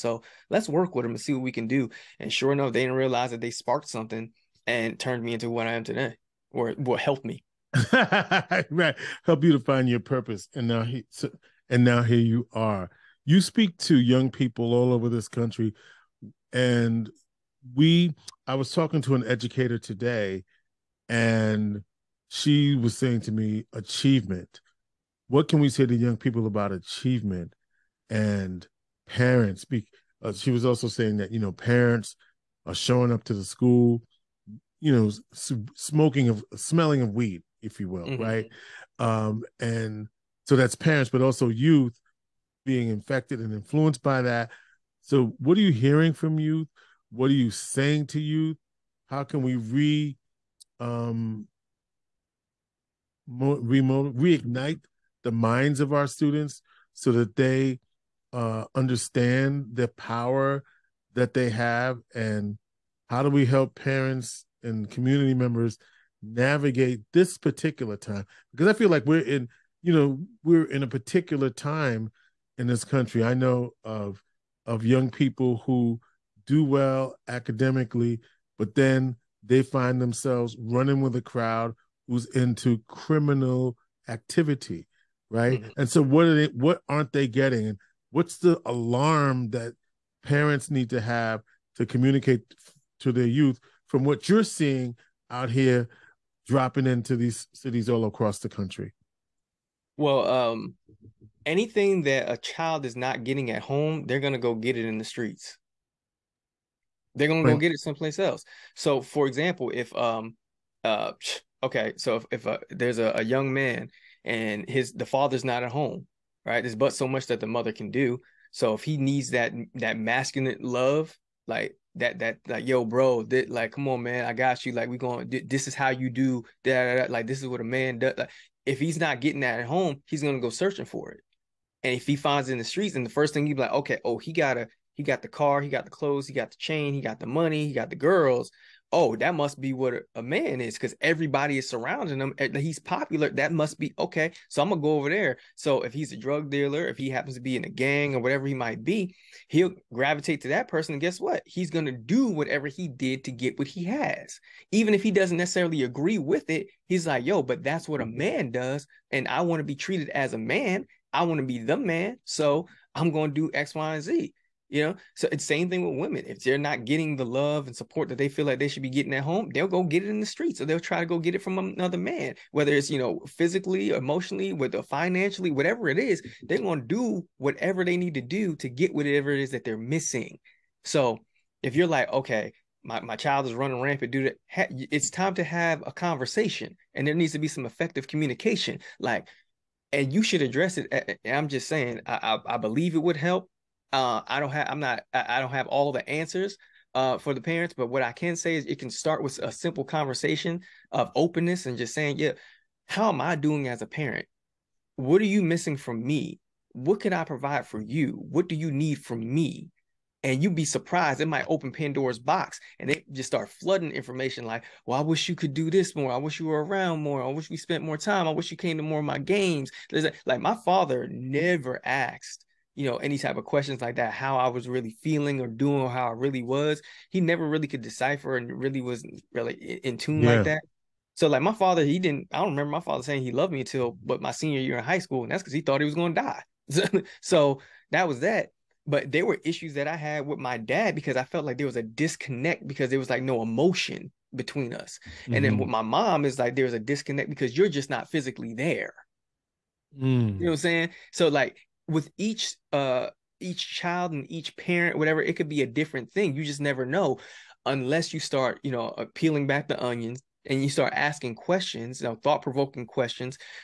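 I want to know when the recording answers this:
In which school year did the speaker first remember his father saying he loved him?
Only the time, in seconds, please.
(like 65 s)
234 s.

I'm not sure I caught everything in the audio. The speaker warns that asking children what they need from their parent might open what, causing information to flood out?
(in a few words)
Pandora's box.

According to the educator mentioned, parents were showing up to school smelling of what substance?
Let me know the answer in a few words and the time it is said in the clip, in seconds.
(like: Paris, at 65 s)
weed, at 37 s.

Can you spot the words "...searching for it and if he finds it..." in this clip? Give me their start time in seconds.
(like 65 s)
130 s.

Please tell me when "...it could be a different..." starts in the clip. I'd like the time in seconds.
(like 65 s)
255 s.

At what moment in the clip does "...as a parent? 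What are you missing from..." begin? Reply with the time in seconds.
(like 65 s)
203 s.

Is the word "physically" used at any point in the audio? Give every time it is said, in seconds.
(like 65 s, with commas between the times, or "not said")
173 s, 248 s.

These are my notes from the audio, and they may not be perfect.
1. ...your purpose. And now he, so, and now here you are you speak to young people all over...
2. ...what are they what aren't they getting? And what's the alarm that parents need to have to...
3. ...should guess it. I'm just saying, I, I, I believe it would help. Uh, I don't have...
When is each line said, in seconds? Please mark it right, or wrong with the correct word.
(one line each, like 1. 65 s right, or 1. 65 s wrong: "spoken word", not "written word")
1. 9 s right
2. 86 s right
3. 190 s wrong: "address", not "guess".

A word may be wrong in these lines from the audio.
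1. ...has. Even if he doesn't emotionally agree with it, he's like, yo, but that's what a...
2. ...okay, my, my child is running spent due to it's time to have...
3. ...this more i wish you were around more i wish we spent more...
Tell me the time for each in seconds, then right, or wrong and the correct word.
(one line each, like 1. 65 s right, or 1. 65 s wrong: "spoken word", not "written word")
1. 153 s wrong: "necessarily", not "emotionally"
2. 182 s wrong: "rampant", not "spent"
3. 215 s right.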